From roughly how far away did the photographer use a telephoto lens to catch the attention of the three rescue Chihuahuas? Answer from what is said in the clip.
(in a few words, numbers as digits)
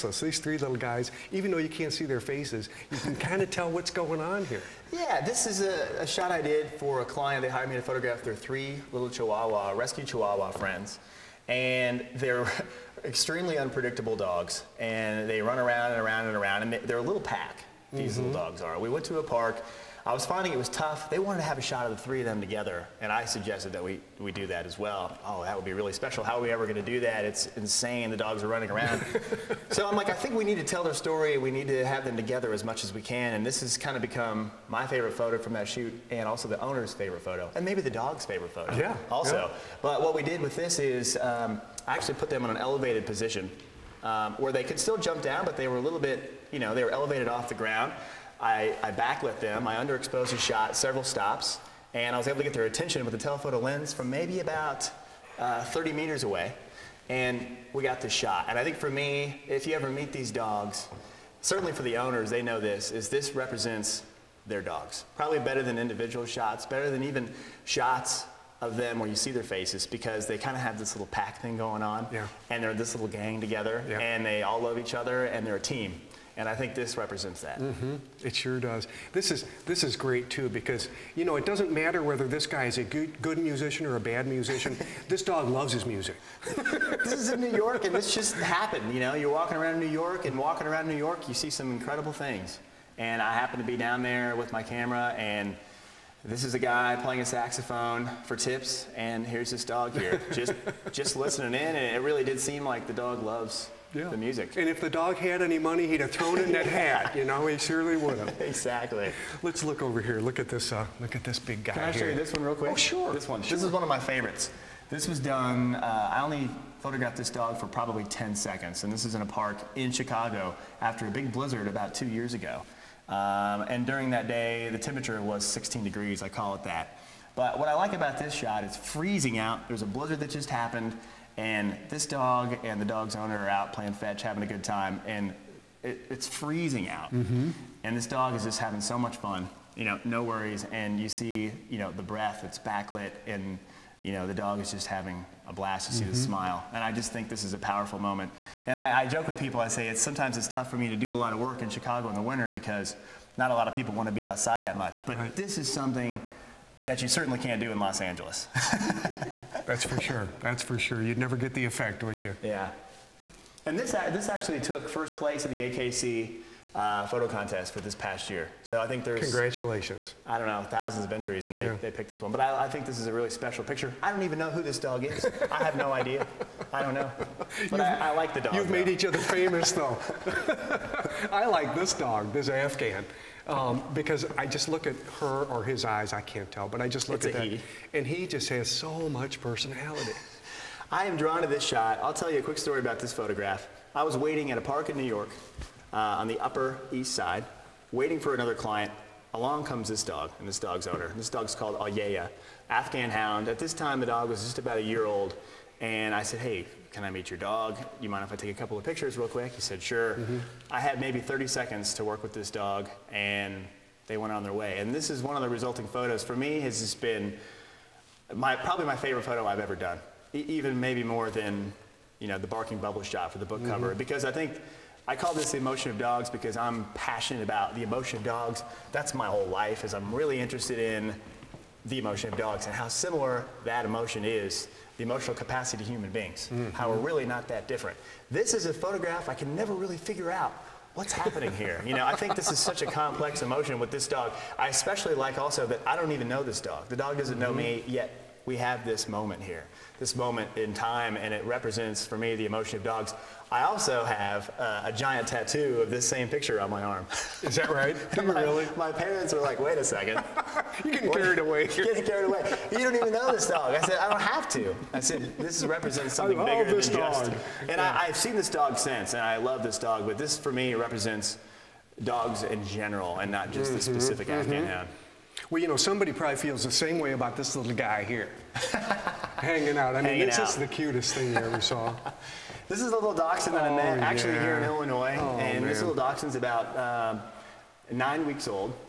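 30 meters.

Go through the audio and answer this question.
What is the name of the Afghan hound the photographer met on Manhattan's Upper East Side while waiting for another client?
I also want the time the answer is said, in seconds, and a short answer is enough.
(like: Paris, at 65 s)
Ayeya, at 201 s.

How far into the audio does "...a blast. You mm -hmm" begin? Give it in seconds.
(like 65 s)
145 s.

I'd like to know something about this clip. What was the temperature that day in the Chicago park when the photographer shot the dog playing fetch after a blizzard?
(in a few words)
16 degrees.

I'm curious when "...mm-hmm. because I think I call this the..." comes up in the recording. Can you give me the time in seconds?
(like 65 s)
223 s.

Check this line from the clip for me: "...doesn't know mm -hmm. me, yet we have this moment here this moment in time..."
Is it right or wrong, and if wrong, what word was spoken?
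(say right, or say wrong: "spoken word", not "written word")
right.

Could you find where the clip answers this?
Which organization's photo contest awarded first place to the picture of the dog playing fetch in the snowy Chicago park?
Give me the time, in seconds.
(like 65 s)
165 s.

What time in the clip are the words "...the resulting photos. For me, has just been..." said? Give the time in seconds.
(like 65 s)
215 s.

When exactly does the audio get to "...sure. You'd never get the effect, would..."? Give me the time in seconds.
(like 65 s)
160 s.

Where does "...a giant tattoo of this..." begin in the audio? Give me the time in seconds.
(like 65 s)
254 s.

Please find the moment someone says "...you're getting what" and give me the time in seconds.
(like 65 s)
260 s.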